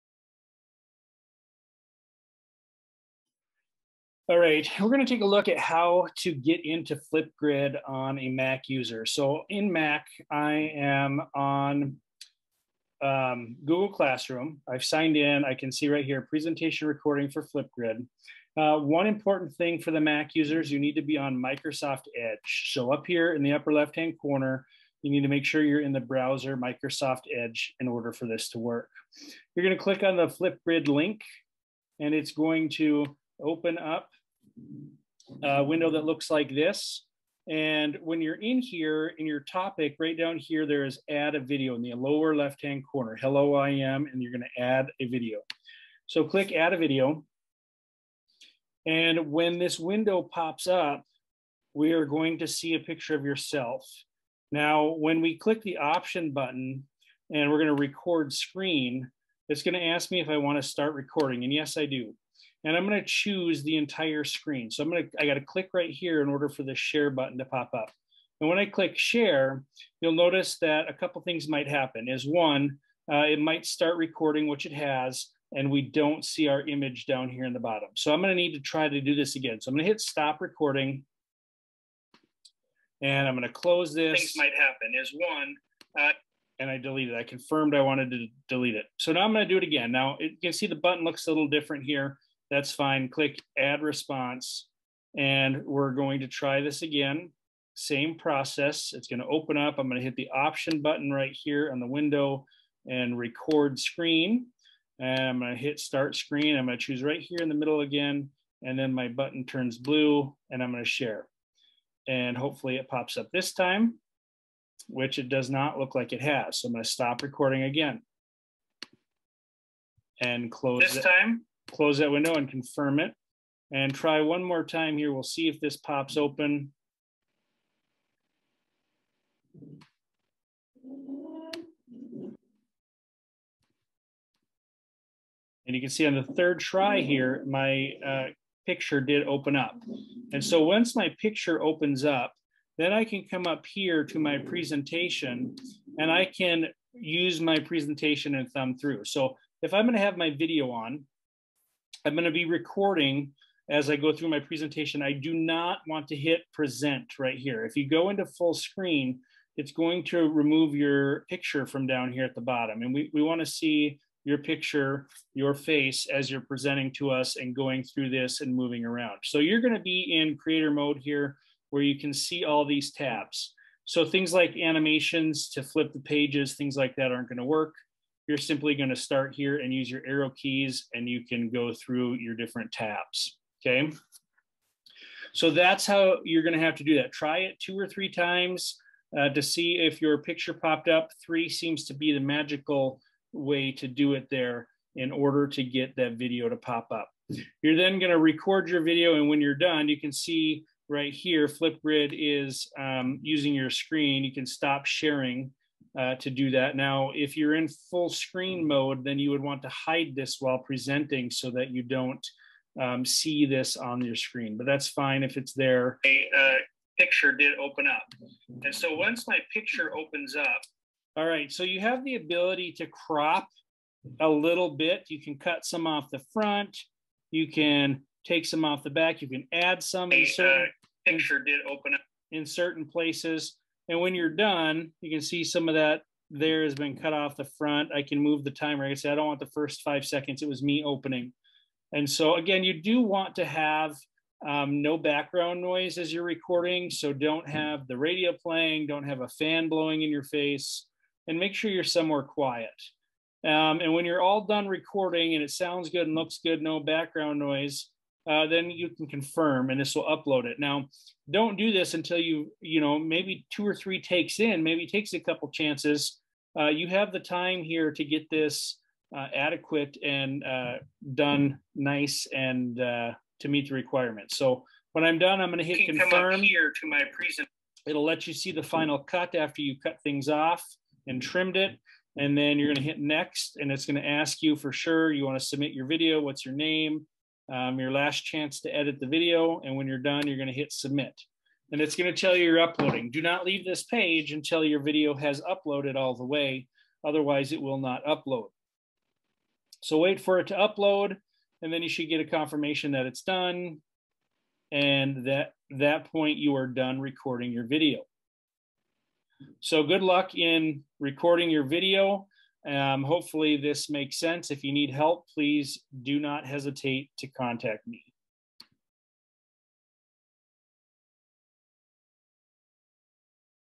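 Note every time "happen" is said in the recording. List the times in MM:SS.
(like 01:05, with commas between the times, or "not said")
01:11, 01:24.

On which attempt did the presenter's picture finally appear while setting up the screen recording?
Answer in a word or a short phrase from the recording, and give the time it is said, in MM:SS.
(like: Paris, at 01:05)
third, at 02:16.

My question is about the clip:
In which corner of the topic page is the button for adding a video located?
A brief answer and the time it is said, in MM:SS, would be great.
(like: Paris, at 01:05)
lower left-hand corner, at 00:41.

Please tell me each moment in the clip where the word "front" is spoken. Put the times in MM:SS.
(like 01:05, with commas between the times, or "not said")
03:46, 03:57.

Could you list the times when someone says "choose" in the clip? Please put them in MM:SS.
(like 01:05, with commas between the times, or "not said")
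01:03, 01:46.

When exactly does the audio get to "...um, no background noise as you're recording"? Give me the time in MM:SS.
04:04.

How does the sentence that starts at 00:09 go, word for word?
So in Mac, I am on um, Google Classroom.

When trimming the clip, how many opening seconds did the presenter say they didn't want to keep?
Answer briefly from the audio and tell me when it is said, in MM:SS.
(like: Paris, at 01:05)
5, at 03:59.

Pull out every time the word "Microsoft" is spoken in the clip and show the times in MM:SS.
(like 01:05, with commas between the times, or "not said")
00:21, 00:26.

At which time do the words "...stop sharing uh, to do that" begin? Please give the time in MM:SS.
03:24.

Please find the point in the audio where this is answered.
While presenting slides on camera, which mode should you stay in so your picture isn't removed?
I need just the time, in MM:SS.
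02:50.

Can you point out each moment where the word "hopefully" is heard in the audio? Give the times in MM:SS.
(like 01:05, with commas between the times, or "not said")
01:52, 05:13.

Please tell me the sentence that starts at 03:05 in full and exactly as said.
So that's how you're going to have to do that.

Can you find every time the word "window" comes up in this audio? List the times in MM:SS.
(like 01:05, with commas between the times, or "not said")
00:35, 00:49, 01:41, 02:02.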